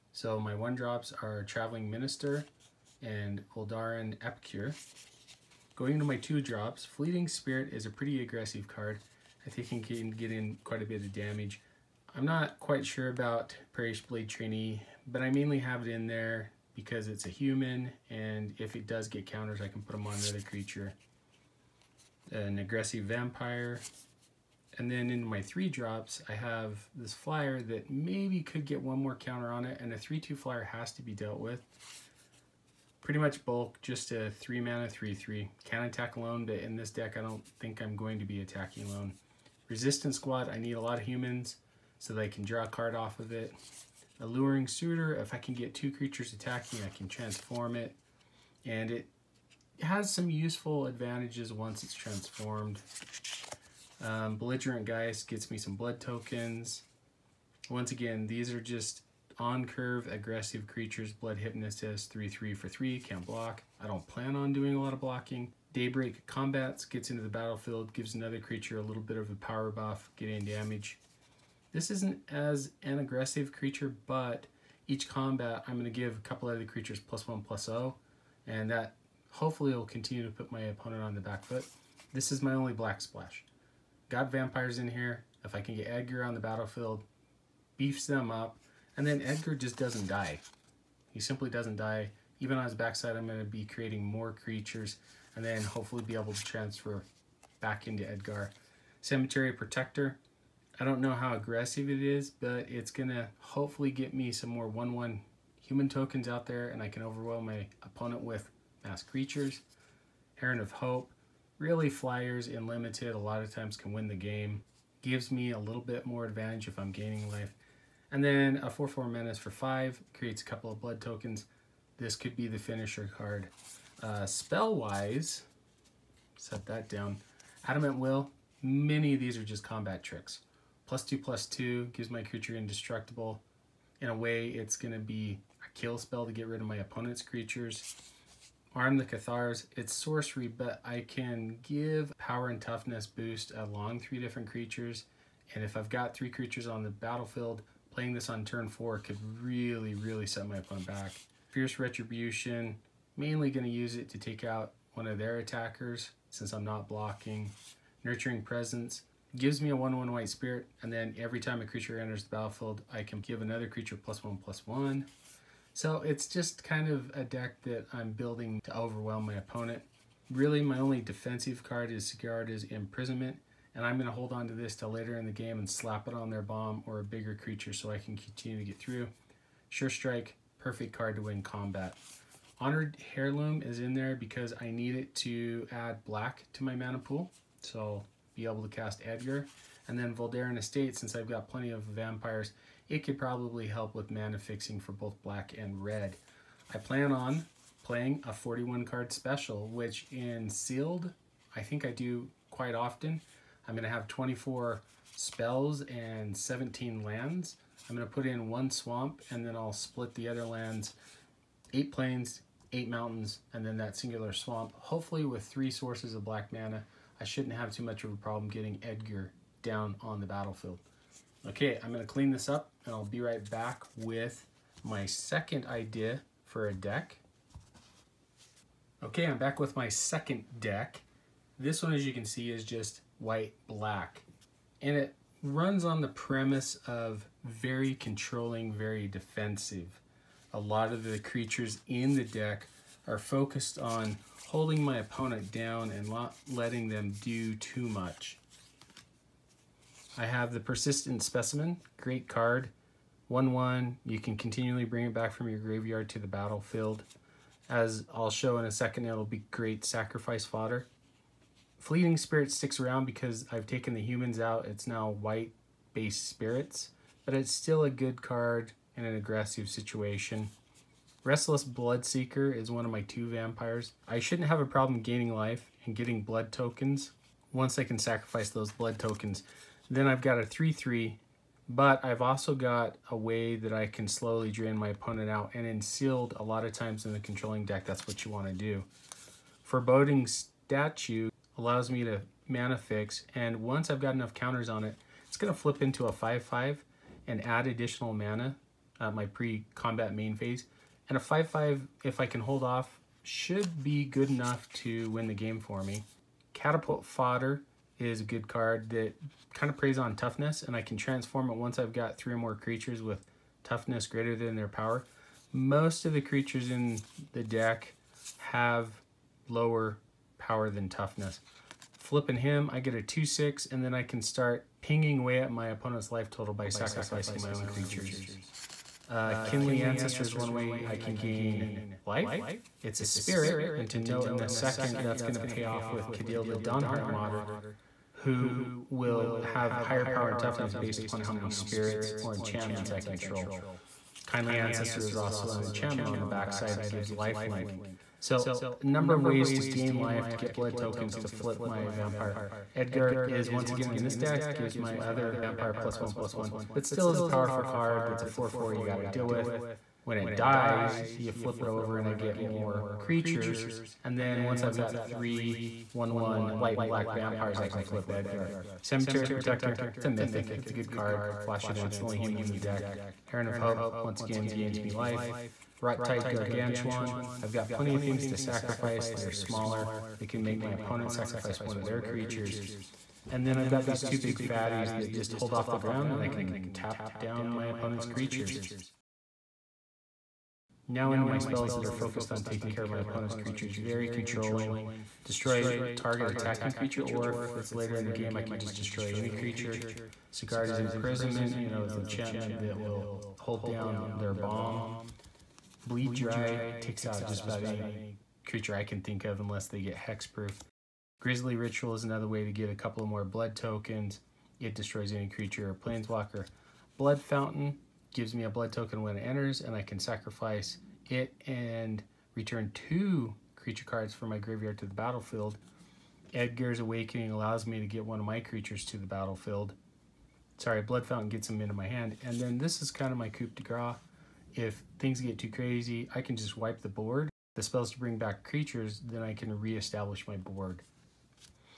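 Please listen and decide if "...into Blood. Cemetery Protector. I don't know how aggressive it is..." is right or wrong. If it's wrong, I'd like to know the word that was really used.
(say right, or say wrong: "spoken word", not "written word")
wrong: "Edgar", not "Blood".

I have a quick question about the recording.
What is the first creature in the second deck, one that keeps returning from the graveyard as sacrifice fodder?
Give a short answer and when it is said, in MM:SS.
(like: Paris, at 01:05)
Persistent Specimen, at 04:10.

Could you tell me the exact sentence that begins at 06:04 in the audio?
And then once I've got three one, one, white and black vampires, I can flip Edgar.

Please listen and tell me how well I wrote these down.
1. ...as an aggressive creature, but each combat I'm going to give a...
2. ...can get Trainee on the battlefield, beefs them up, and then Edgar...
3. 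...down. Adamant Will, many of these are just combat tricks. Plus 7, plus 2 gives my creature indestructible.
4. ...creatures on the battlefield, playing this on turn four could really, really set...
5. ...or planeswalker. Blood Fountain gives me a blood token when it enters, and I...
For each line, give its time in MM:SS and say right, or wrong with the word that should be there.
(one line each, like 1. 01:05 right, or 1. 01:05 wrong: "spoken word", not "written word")
1. 01:12 right
2. 01:25 wrong: "Edgar", not "Trainee"
3. 02:06 wrong: "2", not "7"
4. 02:26 right
5. 06:55 right.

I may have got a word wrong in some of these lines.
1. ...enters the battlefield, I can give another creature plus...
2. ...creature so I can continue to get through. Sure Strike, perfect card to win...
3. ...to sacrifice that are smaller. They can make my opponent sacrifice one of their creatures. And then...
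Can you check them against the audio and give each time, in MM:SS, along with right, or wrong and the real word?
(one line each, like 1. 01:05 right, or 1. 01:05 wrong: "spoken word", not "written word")
1. 02:42 right
2. 02:57 right
3. 06:18 right.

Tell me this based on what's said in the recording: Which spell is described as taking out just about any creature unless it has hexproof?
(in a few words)
Bleed Dry.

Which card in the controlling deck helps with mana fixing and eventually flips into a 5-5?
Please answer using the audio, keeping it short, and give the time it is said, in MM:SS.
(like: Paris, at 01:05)
Foreboding Statue, at 04:49.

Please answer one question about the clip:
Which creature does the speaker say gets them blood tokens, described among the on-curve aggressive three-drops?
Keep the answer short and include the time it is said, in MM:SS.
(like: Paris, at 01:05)
Belligerent Geist, at 00:54.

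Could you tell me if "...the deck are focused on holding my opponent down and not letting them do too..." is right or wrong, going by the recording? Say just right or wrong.
right.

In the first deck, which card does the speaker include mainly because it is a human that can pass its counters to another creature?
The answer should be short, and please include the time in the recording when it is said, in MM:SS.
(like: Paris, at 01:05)
Parish Blade Trainee, at 00:13.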